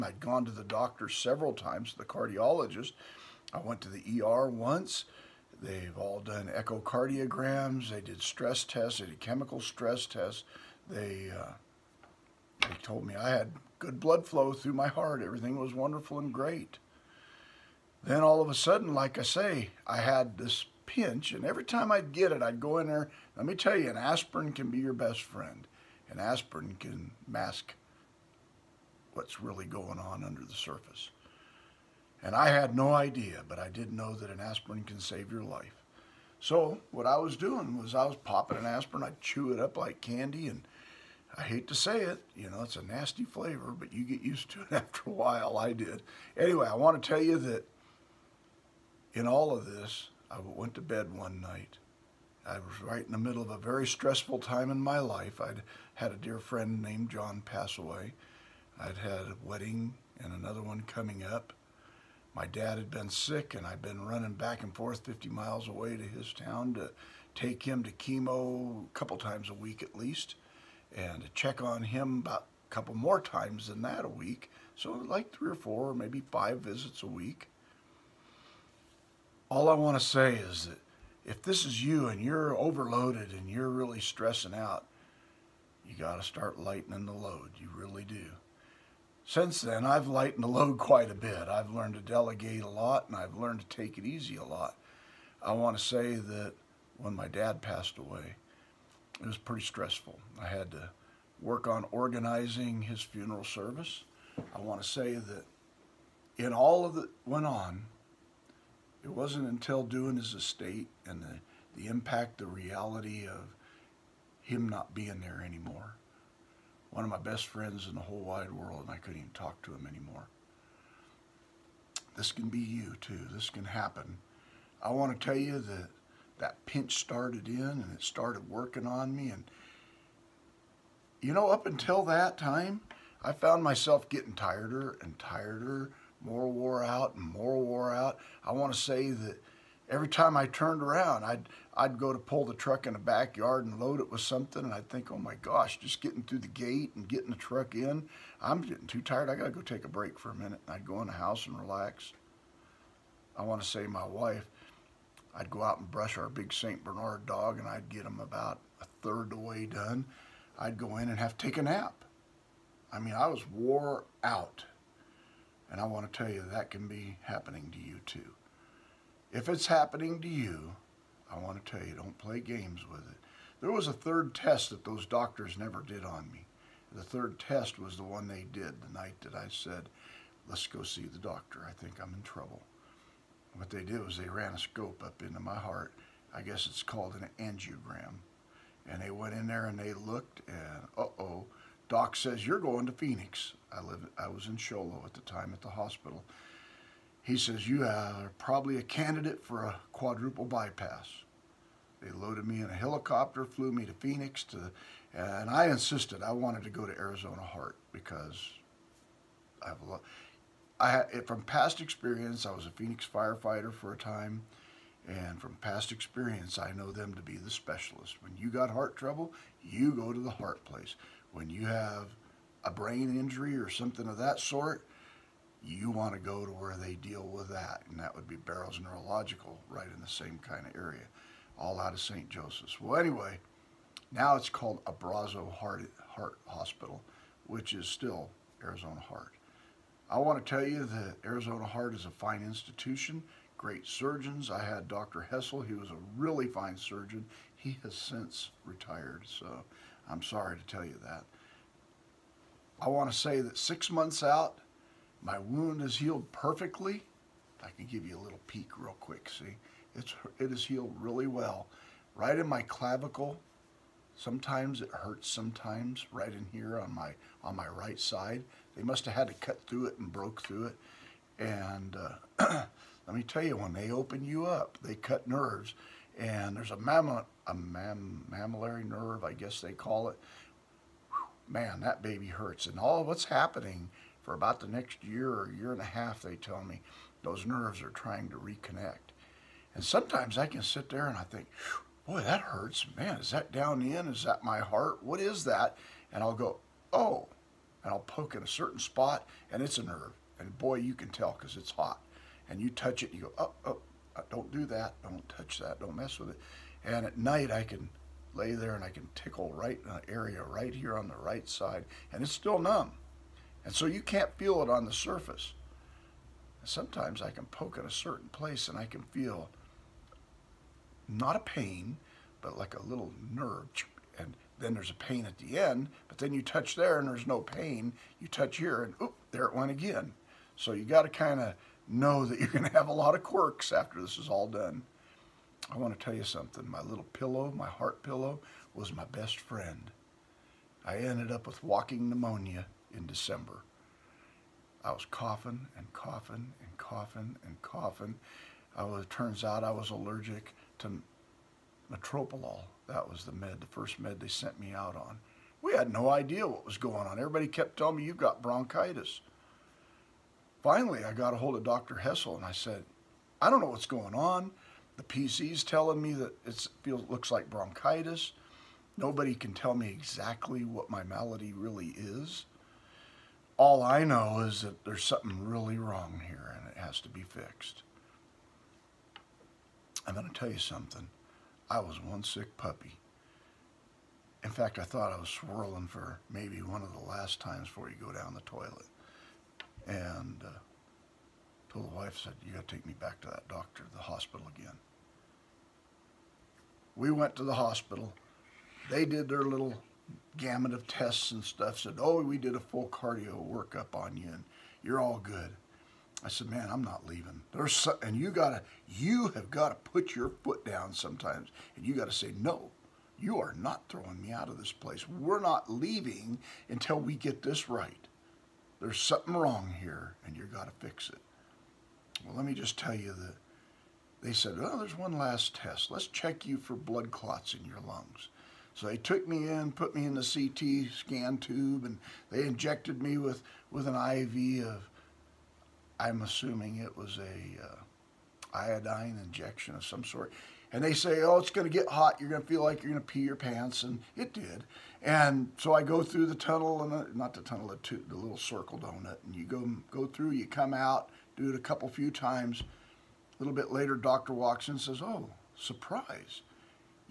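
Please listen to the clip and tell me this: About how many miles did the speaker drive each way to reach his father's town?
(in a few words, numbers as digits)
50.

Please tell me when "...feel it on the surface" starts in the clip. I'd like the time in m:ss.
5:14.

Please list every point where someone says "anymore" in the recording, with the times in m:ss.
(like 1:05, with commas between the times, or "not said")
1:55, 1:59.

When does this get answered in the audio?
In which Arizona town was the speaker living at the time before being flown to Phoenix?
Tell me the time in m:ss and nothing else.
3:14.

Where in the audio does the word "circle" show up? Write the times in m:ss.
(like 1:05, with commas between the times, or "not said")
7:28.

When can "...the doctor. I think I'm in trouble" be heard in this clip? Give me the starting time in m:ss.
3:01.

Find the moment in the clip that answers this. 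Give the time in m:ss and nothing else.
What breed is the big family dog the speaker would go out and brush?
2:36.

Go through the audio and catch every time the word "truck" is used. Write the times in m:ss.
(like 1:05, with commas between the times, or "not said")
2:22, 2:27.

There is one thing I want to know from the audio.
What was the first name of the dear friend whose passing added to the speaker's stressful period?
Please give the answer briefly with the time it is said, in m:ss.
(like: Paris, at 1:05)
John, at 0:57.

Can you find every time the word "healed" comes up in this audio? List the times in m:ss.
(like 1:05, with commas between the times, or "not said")
4:15, 4:20.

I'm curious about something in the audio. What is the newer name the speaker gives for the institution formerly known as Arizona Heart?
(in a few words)
Abrazo Heart.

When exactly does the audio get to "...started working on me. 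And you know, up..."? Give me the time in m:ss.
2:08.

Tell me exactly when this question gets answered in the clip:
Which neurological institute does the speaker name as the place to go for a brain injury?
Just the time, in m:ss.
3:48.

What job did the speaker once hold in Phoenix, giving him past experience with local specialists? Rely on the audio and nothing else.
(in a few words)
Firefighter.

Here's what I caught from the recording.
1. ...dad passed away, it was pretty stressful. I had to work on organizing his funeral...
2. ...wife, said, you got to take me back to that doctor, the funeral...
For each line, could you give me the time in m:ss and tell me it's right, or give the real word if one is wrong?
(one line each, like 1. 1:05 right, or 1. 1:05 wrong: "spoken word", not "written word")
1. 1:37 right
2. 6:31 wrong: "hospital", not "funeral".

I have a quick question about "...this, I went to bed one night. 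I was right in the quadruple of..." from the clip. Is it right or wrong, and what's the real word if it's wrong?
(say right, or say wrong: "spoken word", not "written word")
wrong: "middle", not "quadruple".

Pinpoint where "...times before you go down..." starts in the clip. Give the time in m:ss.
6:27.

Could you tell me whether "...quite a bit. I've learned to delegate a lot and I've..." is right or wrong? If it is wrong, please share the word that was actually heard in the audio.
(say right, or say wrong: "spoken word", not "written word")
right.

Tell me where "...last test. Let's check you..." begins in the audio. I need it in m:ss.
7:05.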